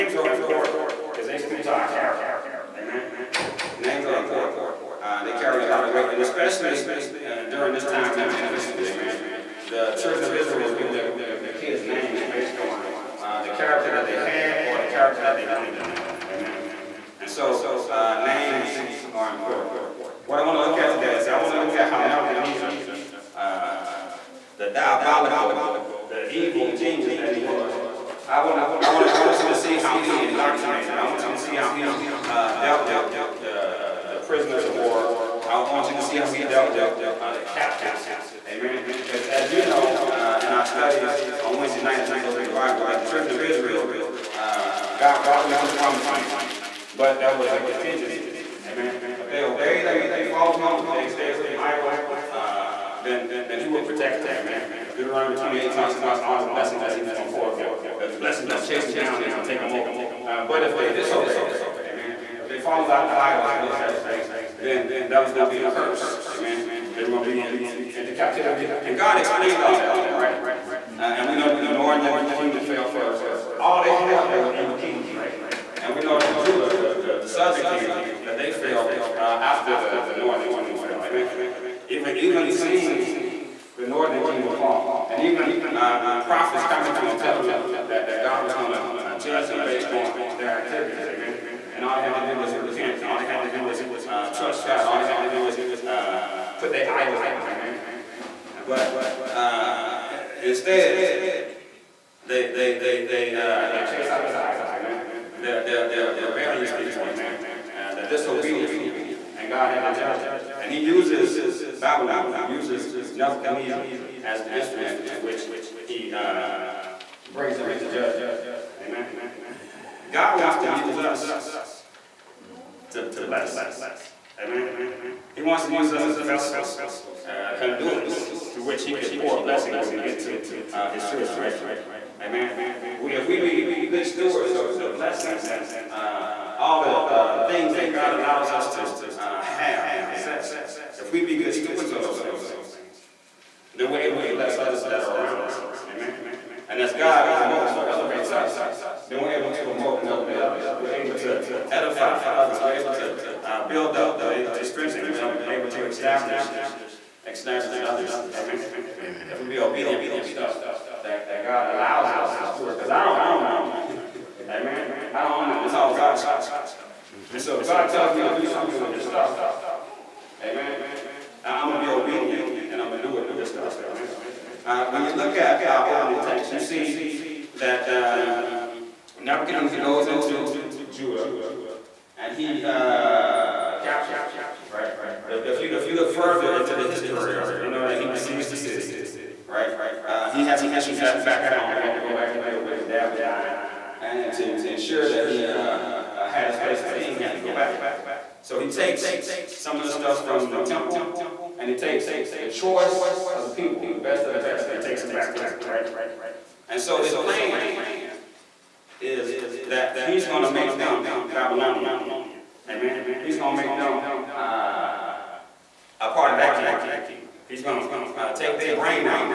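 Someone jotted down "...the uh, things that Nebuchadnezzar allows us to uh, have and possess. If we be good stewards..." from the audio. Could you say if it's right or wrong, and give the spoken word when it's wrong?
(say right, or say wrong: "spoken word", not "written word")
wrong: "God", not "Nebuchadnezzar".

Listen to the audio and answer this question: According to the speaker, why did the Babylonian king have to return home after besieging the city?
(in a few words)
His dad was dying.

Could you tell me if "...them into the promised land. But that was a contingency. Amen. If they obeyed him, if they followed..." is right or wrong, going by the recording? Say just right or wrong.
right.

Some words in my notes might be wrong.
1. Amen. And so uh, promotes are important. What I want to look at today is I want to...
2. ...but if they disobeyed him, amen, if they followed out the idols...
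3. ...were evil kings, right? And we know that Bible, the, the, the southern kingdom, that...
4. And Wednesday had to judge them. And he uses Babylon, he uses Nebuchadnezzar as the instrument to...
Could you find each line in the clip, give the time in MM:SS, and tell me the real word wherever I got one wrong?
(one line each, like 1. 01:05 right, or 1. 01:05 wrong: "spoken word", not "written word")
1. 00:16 wrong: "names", not "promotes"
2. 01:00 right
3. 01:14 wrong: "Judah", not "Bible"
4. 01:49 wrong: "God", not "Wednesday".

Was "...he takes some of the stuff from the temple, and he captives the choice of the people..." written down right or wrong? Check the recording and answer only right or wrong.
wrong.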